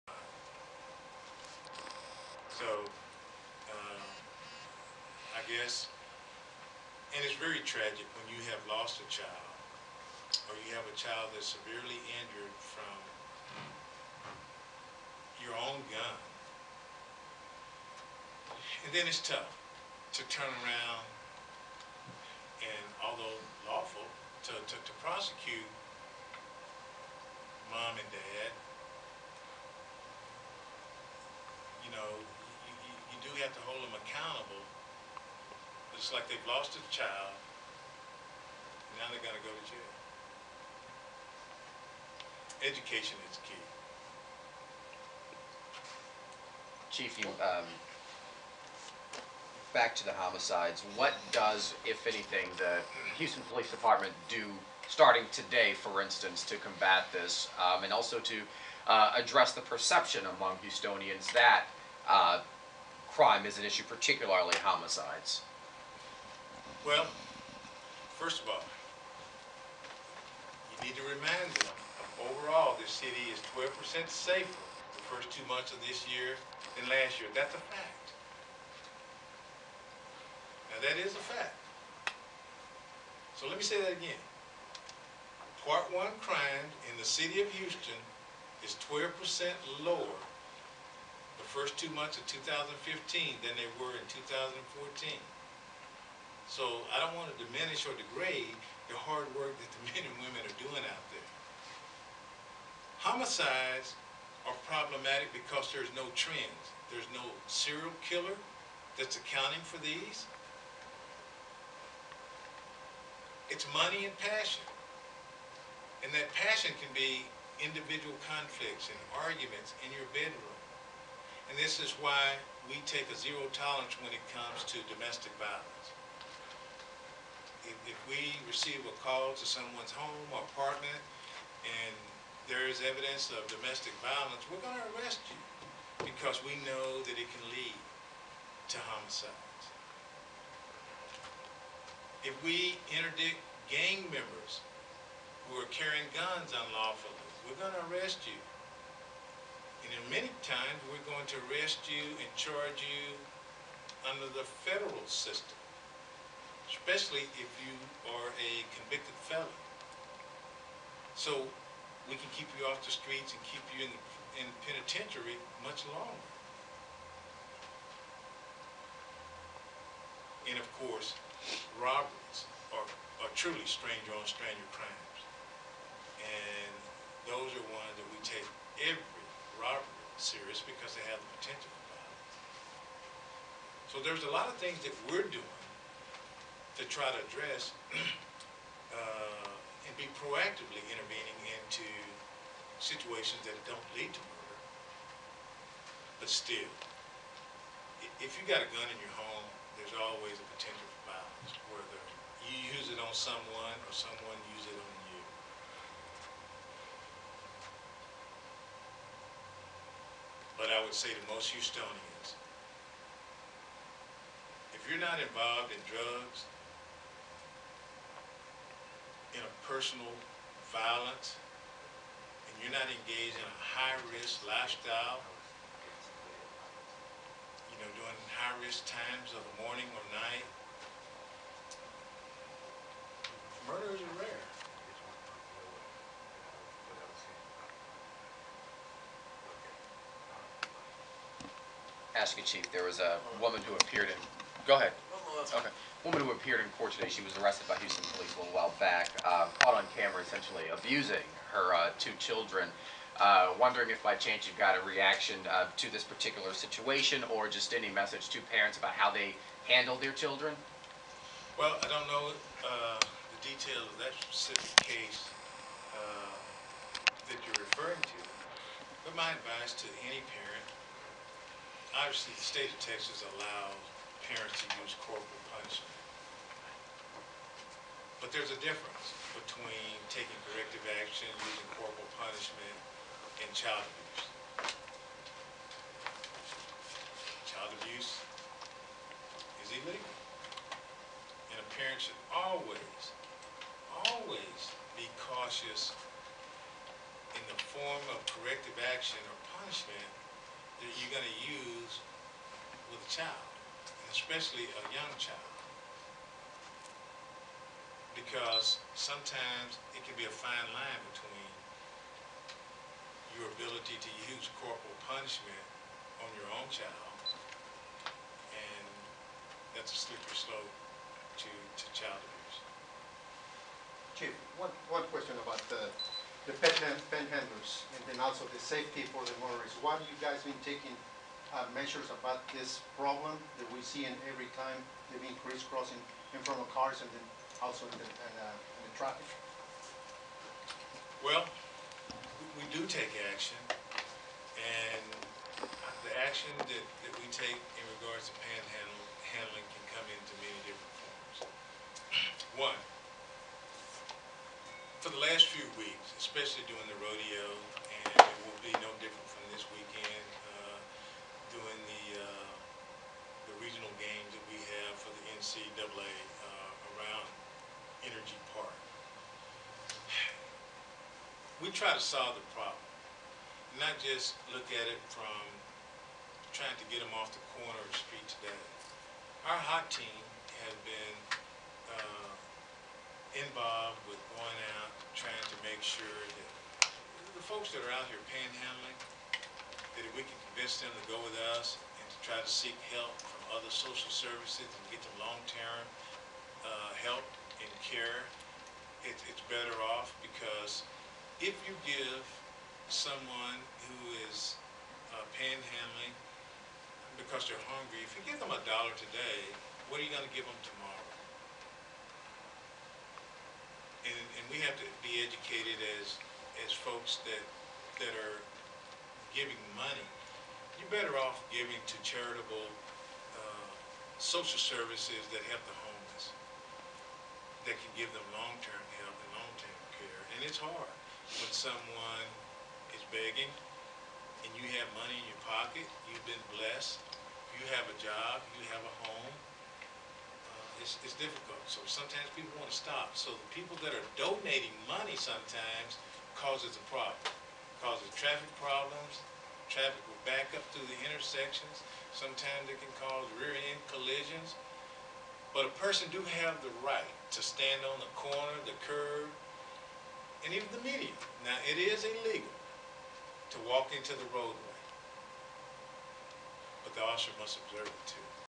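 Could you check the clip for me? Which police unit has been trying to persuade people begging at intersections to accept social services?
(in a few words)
HOT team.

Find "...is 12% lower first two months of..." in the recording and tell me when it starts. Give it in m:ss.
1:28.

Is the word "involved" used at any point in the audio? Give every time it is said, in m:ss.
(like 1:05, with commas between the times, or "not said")
3:35, 6:23.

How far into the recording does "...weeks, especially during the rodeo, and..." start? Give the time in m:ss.
5:55.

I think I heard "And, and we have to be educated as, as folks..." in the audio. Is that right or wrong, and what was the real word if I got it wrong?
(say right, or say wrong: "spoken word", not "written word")
right.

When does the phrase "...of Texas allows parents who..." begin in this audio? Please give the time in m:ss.
4:32.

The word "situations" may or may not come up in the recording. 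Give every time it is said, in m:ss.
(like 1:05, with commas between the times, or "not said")
3:12, 4:16.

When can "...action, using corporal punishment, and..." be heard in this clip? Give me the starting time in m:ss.
4:41.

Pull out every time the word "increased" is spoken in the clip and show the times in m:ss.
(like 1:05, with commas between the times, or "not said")
5:35.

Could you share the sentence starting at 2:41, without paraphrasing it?
So we can keep you off the streets and keep you in, the, in the penitentiary much longer.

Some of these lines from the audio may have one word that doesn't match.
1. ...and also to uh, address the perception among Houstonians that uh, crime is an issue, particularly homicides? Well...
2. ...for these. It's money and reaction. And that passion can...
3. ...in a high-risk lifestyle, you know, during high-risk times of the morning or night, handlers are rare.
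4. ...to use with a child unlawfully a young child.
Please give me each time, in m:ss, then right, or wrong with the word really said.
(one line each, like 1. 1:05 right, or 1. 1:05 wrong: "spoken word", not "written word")
1. 0:57 right
2. 1:49 wrong: "passion", not "reaction"
3. 3:43 wrong: "murders", not "handlers"
4. 5:01 wrong: "especially", not "unlawfully".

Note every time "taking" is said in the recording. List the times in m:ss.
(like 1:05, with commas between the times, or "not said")
4:40, 5:30.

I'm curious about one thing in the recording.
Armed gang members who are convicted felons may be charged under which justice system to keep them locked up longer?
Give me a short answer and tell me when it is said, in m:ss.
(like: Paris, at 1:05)
Federal system, at 2:34.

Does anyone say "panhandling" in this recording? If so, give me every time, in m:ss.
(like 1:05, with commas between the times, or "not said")
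5:48, 6:28, 6:45.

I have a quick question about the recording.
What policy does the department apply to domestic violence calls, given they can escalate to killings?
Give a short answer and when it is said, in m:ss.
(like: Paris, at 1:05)
Zero tolerance, at 2:03.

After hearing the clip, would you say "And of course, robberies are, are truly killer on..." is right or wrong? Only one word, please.
wrong.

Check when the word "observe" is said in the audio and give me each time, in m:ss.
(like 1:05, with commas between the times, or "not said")
7:47.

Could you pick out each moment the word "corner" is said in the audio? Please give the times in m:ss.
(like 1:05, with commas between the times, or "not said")
6:17, 7:38.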